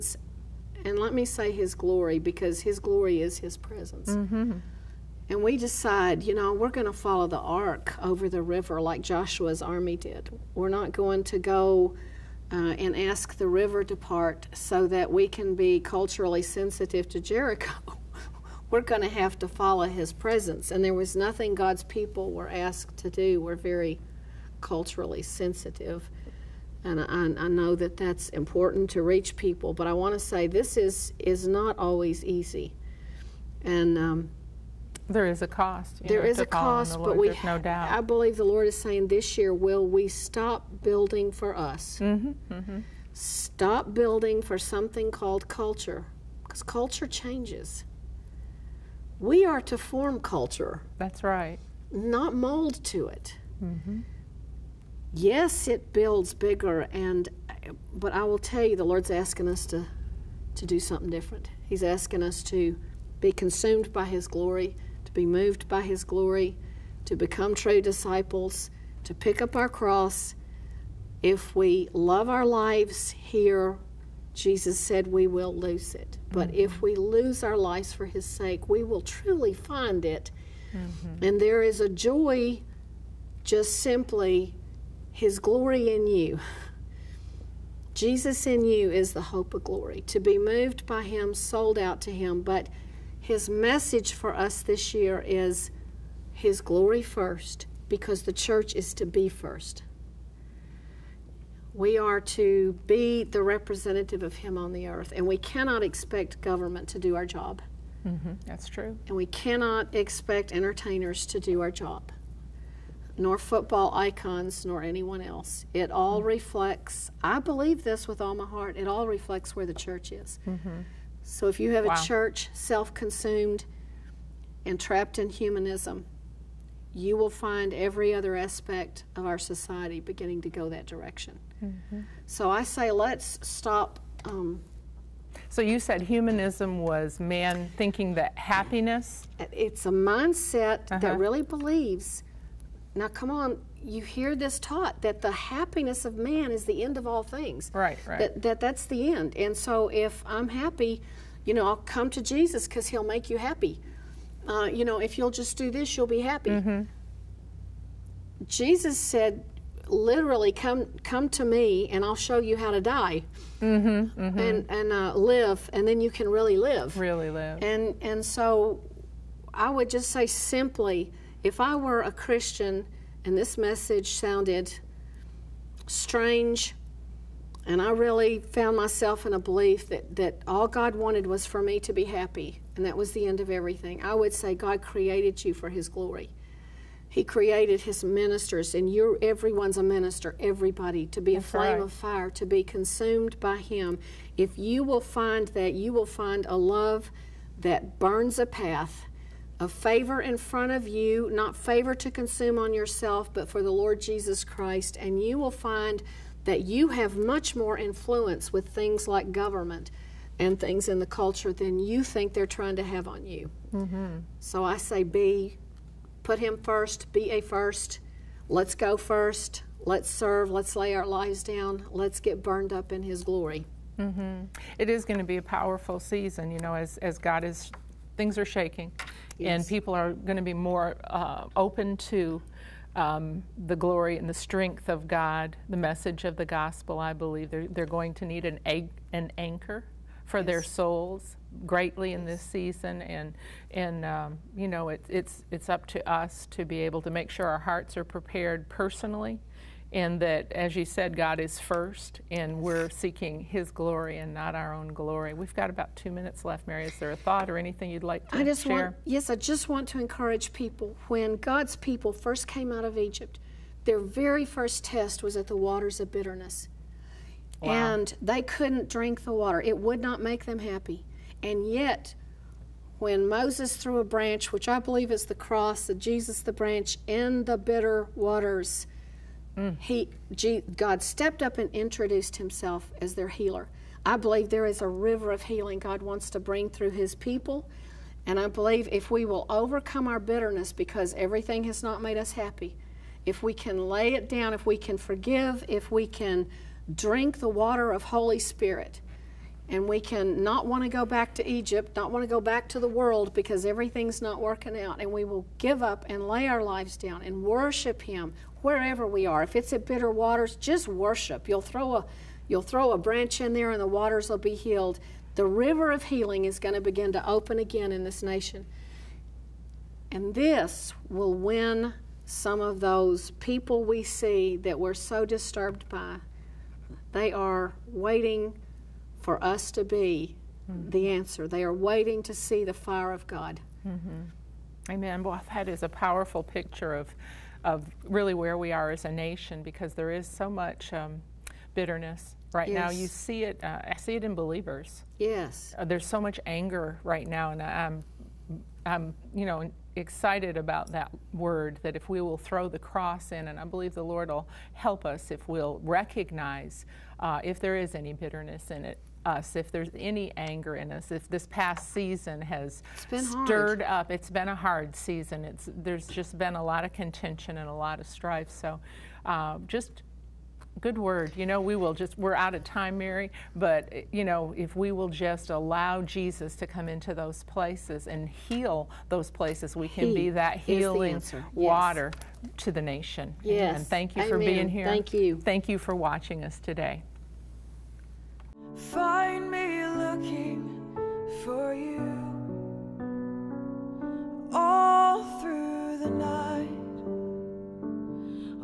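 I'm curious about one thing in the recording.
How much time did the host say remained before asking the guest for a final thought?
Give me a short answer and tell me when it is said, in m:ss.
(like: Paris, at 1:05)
2 minutes, at 4:15.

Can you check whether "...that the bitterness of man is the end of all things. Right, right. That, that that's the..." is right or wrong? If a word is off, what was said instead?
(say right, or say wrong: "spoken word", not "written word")
wrong: "happiness", not "bitterness".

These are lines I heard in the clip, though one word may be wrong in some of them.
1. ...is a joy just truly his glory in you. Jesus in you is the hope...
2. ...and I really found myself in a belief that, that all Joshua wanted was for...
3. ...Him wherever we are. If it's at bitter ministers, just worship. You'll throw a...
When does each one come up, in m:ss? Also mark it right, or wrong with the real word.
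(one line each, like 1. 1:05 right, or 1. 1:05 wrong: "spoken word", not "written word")
1. 1:21 wrong: "simply", not "truly"
2. 2:57 wrong: "God", not "Joshua"
3. 5:08 wrong: "waters", not "ministers".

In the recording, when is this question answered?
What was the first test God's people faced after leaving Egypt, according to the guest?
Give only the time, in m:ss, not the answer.
4:25.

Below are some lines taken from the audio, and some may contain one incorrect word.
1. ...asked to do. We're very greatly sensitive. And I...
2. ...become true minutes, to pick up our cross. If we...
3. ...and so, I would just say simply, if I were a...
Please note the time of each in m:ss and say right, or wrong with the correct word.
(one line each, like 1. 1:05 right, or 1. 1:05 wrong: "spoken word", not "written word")
1. 0:22 wrong: "culturally", not "greatly"
2. 1:07 wrong: "disciples", not "minutes"
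3. 2:48 right.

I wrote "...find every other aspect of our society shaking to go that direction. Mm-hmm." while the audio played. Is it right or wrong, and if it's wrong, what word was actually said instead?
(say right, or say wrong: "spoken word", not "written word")
wrong: "beginning", not "shaking".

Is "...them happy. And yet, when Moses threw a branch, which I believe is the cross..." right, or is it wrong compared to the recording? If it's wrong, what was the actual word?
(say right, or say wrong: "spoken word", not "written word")
right.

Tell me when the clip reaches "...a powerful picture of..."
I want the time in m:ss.
5:35.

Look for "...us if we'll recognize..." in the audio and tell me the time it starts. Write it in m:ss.
5:55.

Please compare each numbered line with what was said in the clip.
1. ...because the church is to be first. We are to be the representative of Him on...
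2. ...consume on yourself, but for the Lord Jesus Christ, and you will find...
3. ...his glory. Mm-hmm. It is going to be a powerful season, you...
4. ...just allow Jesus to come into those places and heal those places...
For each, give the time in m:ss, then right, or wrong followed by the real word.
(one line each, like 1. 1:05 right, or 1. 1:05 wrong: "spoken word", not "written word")
1. 1:37 right
2. 3:22 right
3. 3:43 right
4. 6:15 right.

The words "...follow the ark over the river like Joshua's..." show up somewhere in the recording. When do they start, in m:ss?
0:07.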